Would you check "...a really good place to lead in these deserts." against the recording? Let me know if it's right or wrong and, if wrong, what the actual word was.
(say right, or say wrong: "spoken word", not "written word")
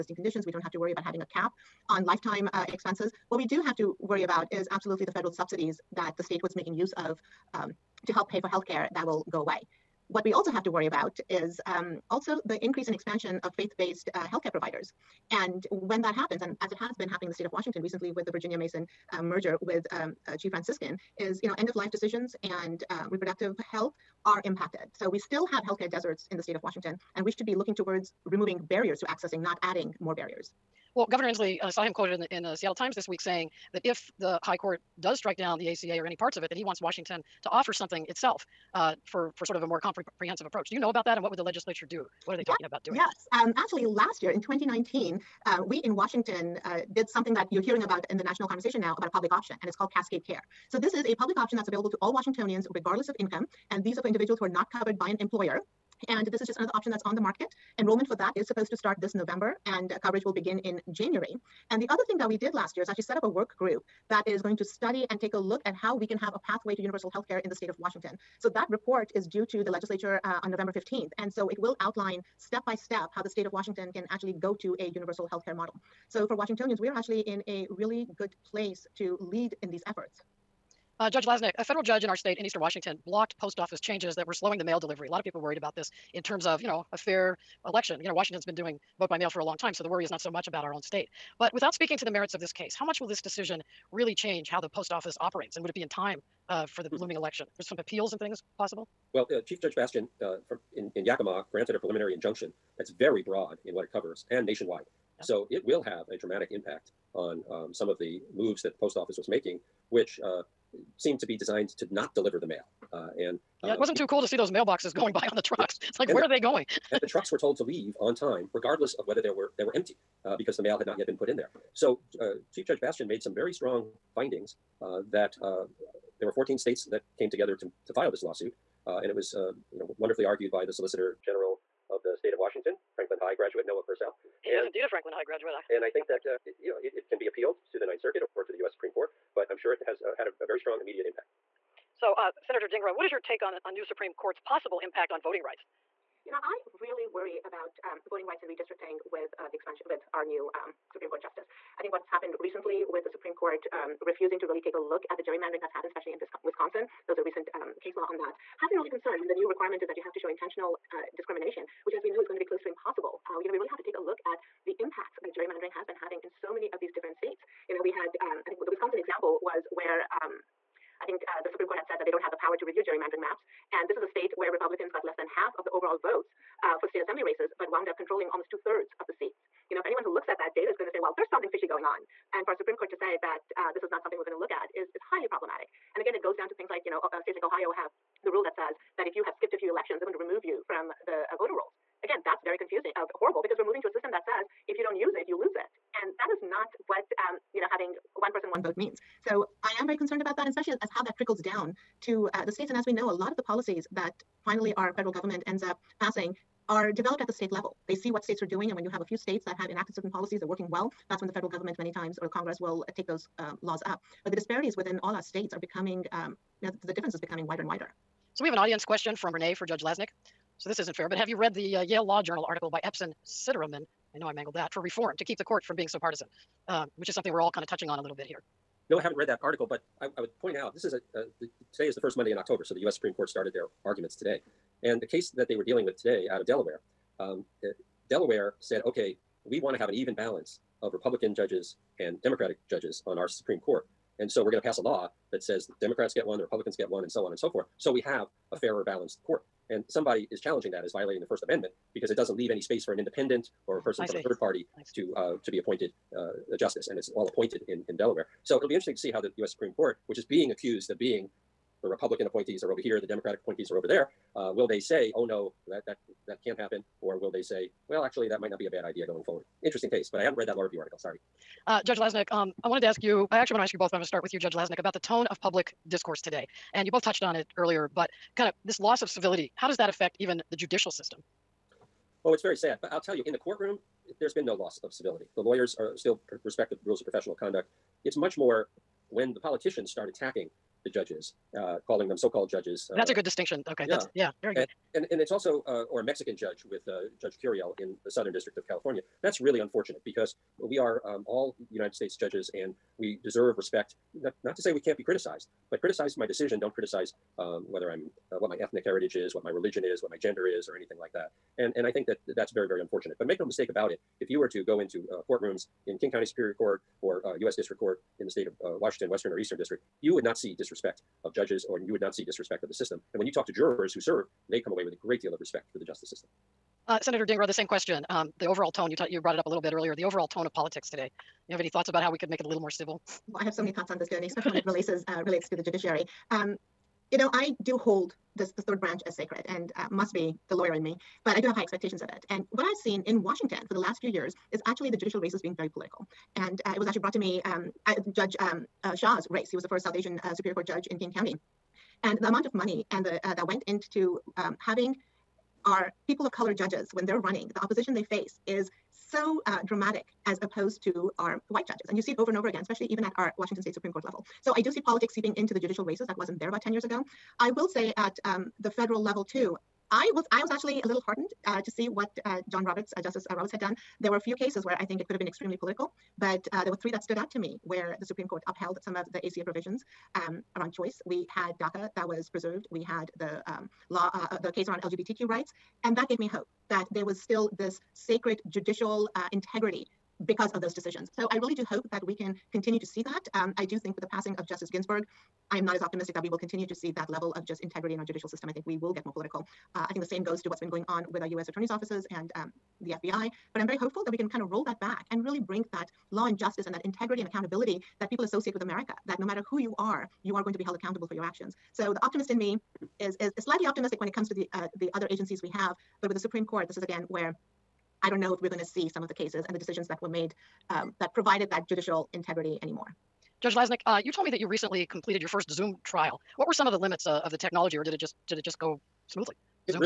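wrong: "efforts", not "deserts".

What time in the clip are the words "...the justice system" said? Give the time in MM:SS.
05:25.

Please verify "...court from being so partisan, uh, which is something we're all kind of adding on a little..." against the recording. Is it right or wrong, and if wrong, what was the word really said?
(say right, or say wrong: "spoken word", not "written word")
wrong: "touching", not "adding".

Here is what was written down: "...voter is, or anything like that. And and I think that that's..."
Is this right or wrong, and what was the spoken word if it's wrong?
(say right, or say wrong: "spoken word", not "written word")
wrong: "gender", not "voter".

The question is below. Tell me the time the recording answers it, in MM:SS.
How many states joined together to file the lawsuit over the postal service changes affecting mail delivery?
02:06.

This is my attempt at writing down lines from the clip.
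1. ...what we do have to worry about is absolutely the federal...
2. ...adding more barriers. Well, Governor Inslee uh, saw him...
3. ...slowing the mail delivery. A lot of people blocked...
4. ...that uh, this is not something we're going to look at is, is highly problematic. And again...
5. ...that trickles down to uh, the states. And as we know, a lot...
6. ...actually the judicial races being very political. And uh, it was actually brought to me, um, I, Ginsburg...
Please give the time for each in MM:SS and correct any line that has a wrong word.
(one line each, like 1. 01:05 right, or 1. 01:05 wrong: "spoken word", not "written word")
1. 00:03 right
2. 00:29 right
3. 01:24 wrong: "worried", not "blocked"
4. 03:03 right
5. 03:21 right
6. 05:44 wrong: "Judge", not "Ginsburg".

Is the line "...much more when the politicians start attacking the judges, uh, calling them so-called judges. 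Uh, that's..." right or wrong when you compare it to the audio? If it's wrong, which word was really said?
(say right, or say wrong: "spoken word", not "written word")
right.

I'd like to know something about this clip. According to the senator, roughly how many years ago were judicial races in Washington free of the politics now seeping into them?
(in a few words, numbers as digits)
10 years.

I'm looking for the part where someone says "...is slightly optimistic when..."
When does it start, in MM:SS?
06:53.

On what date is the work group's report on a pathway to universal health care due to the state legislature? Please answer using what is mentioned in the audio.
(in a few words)
November 15th.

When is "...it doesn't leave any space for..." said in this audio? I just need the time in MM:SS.
04:12.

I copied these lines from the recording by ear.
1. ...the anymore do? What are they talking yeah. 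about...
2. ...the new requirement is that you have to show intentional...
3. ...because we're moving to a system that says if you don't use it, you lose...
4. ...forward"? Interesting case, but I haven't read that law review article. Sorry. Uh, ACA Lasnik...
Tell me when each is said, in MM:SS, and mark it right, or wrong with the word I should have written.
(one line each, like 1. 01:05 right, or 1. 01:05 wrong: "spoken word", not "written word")
1. 00:41 wrong: "legislature", not "anymore"
2. 02:39 right
3. 03:13 right
4. 04:29 wrong: "Judge", not "ACA".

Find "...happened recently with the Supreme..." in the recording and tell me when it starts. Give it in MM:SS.
02:32.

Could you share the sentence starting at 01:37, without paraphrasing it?
There's some appeals and things possible?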